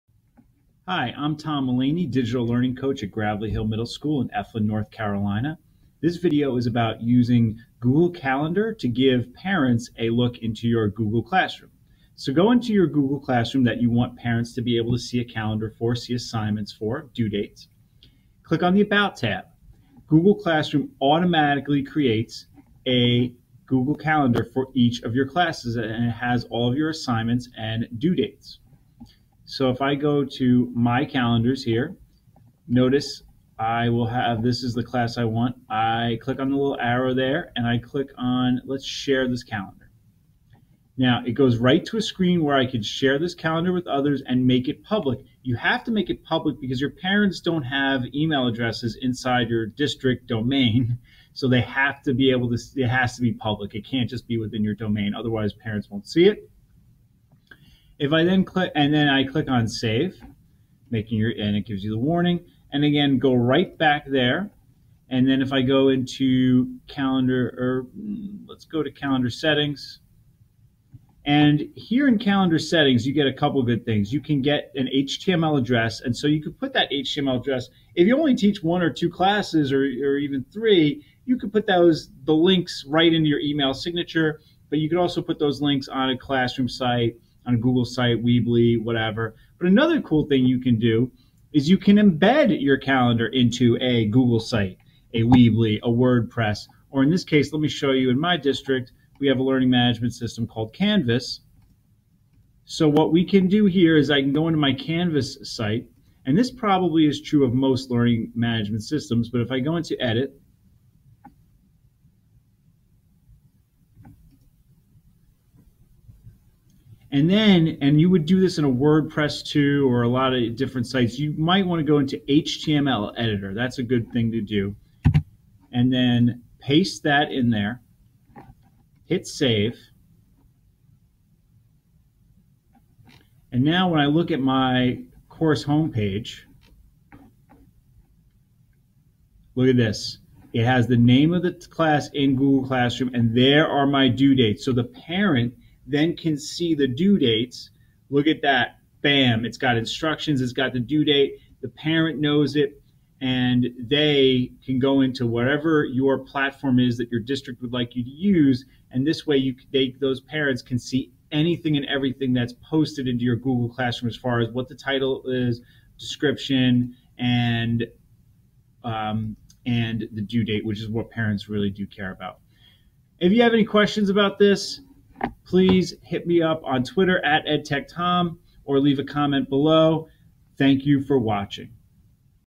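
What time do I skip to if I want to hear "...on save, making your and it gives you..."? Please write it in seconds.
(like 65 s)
59 s.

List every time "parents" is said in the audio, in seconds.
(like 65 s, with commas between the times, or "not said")
9 s, 14 s, 46 s, 55 s, 144 s, 151 s, 160 s, 171 s.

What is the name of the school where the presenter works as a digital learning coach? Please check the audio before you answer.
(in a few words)
Gravelly Hill Middle School.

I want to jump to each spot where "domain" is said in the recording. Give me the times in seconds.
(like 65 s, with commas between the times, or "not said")
50 s, 54 s.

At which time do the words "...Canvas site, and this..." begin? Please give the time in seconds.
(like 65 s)
104 s.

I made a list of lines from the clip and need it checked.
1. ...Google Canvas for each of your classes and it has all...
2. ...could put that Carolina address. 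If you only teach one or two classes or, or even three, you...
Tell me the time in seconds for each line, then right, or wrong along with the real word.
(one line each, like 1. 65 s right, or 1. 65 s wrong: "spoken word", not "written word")
1. 23 s wrong: "Calendar", not "Canvas"
2. 76 s wrong: "HTML", not "Carolina".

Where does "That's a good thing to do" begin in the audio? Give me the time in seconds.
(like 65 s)
123 s.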